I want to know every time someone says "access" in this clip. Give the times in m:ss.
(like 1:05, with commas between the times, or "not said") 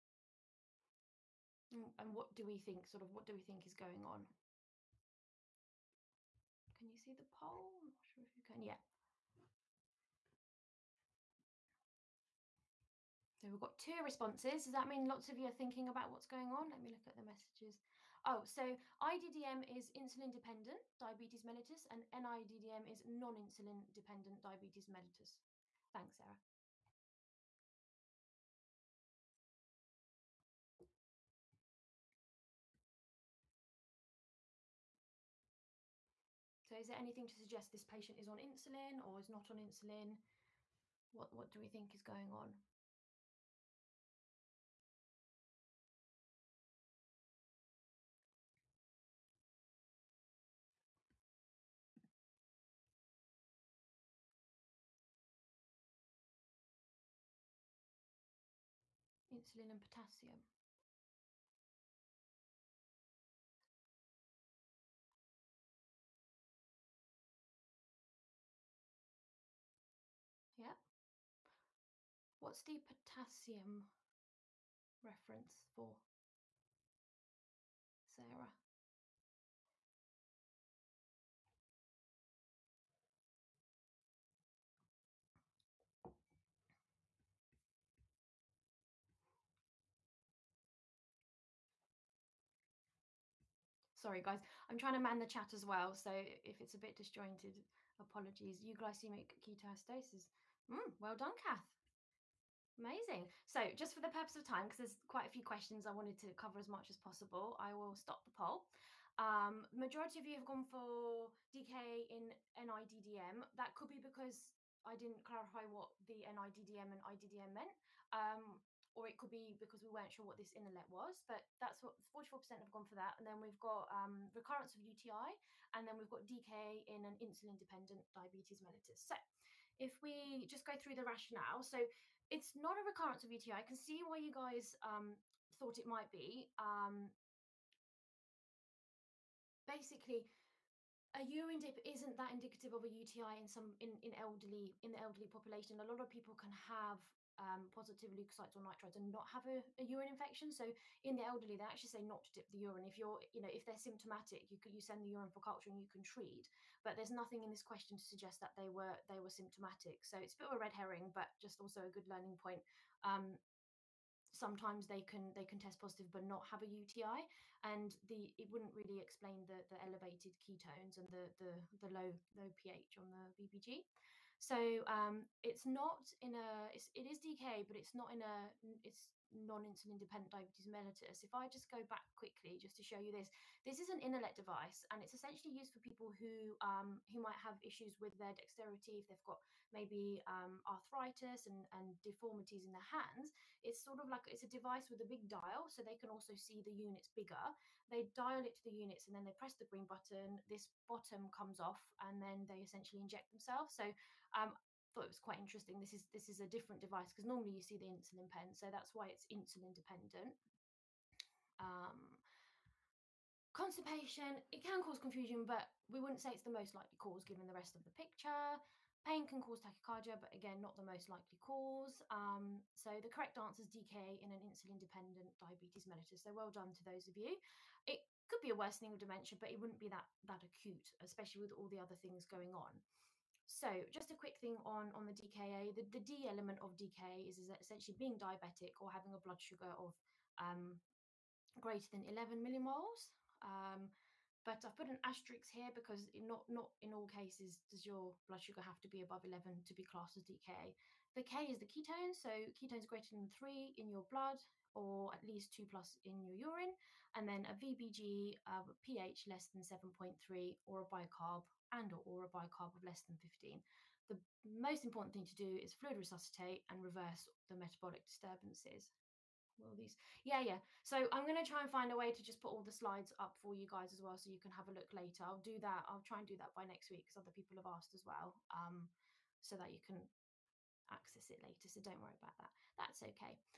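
4:40.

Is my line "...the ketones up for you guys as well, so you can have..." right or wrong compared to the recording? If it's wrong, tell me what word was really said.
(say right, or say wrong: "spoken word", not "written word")
wrong: "slides", not "ketones".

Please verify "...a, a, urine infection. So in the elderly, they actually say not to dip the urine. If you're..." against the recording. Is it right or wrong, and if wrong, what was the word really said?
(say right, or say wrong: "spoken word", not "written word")
right.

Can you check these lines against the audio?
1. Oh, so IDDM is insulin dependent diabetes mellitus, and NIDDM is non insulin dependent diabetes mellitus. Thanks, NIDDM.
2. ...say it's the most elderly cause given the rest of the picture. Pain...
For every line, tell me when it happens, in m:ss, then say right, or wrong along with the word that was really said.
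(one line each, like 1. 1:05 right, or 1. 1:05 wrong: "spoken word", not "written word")
1. 0:18 wrong: "Sarah", not "NIDDM"
2. 3:36 wrong: "likely", not "elderly".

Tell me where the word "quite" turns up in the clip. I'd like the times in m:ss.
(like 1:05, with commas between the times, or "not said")
1:45, 3:25.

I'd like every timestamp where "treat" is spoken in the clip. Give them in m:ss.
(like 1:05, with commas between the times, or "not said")
2:36.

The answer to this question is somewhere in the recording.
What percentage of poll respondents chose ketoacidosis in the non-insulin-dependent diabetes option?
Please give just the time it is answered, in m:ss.
2:02.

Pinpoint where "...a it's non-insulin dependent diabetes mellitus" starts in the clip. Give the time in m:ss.
2:58.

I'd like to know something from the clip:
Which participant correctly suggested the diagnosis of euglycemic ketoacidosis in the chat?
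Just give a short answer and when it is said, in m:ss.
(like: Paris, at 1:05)
Kath, at 1:41.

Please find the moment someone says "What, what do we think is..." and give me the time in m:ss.
0:41.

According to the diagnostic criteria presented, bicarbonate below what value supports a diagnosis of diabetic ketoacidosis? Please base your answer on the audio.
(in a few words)
15.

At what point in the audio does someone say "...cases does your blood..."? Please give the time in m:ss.
4:07.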